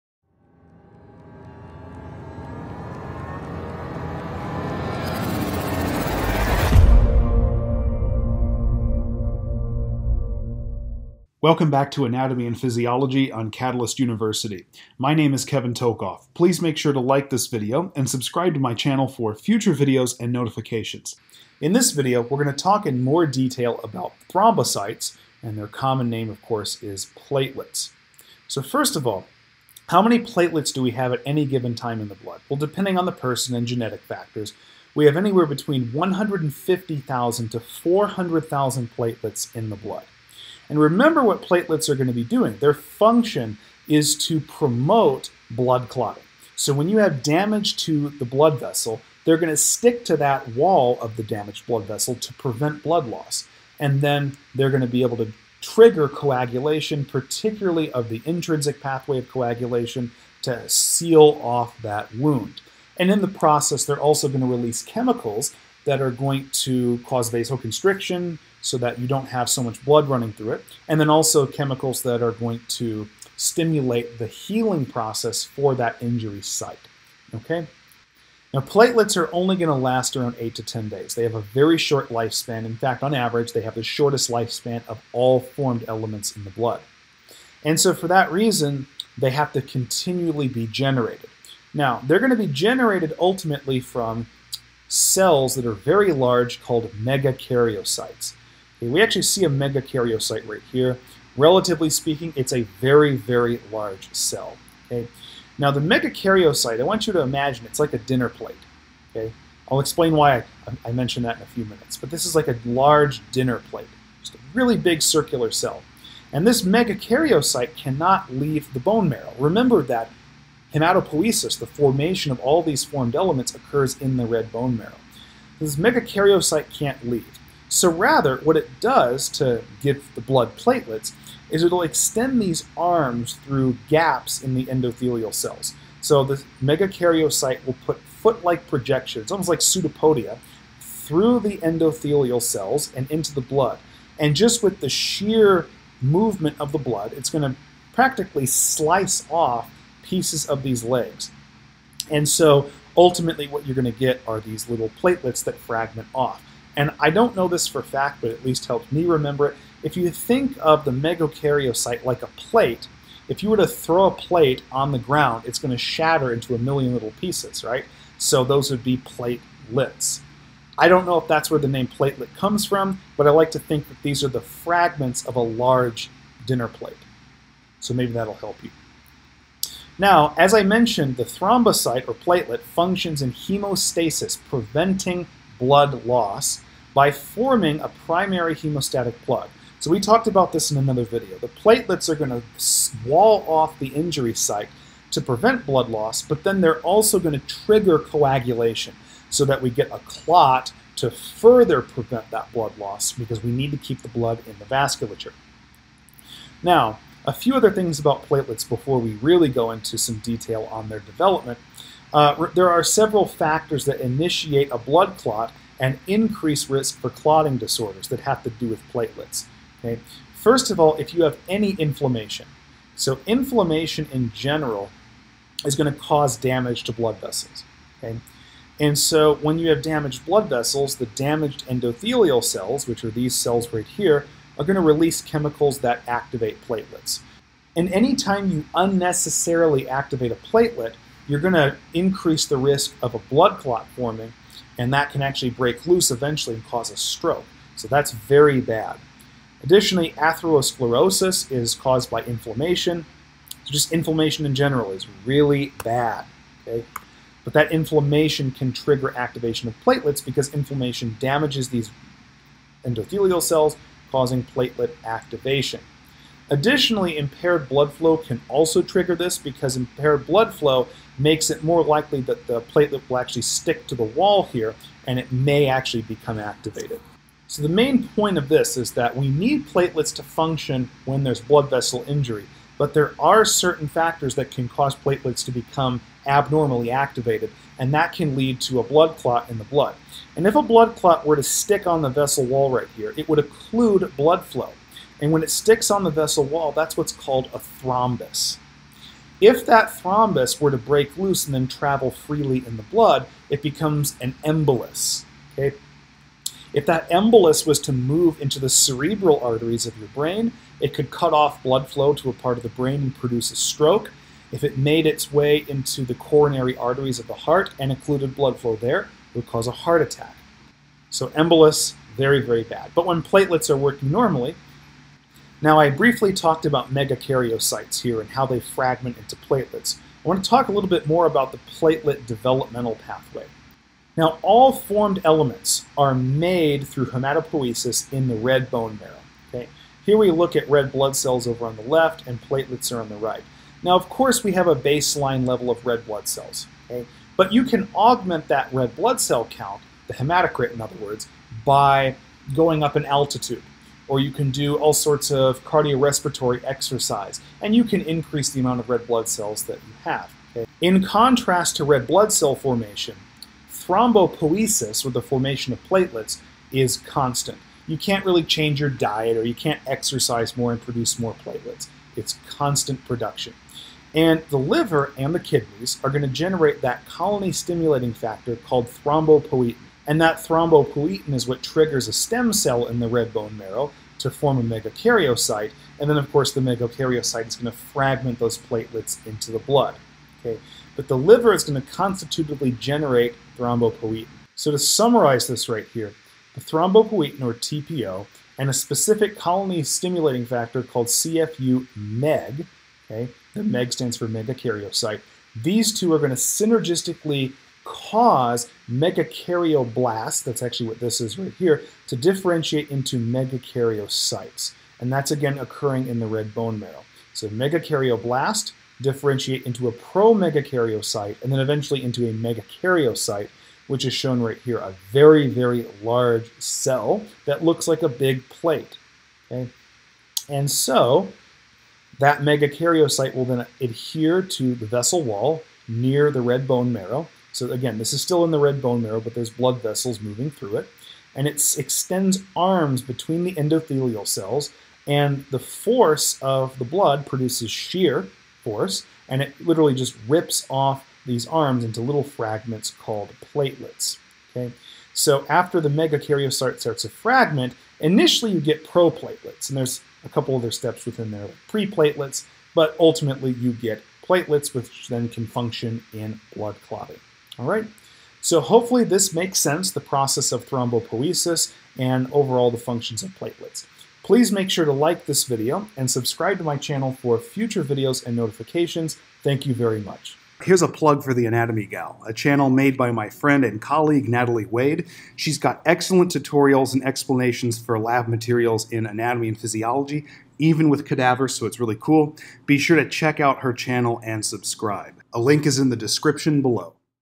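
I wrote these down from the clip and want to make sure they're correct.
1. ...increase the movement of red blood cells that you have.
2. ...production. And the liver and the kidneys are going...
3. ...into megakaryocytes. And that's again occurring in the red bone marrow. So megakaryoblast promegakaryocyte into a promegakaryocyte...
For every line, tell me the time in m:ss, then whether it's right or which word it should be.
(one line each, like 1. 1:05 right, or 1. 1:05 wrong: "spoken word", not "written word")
1. 5:58 wrong: "amount", not "movement"
2. 6:13 right
3. 6:52 wrong: "differentiate", not "promegakaryocyte".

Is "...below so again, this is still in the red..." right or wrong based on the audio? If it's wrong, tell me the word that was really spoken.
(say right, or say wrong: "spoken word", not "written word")
wrong: "marrow", not "below".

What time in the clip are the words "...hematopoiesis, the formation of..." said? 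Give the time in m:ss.
2:00.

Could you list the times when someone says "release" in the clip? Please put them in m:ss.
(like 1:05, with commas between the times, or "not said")
1:04, 3:54.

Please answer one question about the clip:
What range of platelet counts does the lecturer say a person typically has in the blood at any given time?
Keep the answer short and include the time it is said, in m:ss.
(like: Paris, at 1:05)
150,000 to 400,000, at 0:35.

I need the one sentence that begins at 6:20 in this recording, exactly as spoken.
And that thrombopoietin is what triggers a stem cell in the red bone marrow to form a megakaryocyte.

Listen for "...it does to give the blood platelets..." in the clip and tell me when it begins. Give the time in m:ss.
2:08.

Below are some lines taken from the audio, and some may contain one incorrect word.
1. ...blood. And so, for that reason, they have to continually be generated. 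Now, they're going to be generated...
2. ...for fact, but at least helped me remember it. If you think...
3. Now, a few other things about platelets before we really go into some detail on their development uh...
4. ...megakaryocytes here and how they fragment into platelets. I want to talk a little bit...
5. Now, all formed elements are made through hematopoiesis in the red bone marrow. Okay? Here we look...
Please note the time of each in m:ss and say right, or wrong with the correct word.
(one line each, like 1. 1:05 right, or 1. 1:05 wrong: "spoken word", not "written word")
1. 1:26 right
2. 2:37 right
3. 3:26 right
4. 5:26 right
5. 5:34 right.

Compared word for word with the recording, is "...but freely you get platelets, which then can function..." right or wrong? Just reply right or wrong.
wrong.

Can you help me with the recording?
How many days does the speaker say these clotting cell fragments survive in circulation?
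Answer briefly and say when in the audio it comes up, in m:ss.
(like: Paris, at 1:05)
8 to 10 days, at 1:20.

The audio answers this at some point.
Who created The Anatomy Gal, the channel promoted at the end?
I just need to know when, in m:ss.
8:04.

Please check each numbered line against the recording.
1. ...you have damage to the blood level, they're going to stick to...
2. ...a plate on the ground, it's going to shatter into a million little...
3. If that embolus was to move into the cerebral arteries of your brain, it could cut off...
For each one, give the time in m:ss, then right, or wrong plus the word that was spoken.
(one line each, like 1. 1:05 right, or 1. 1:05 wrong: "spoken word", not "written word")
1. 0:46 wrong: "vessel", not "level"
2. 2:44 right
3. 5:06 right.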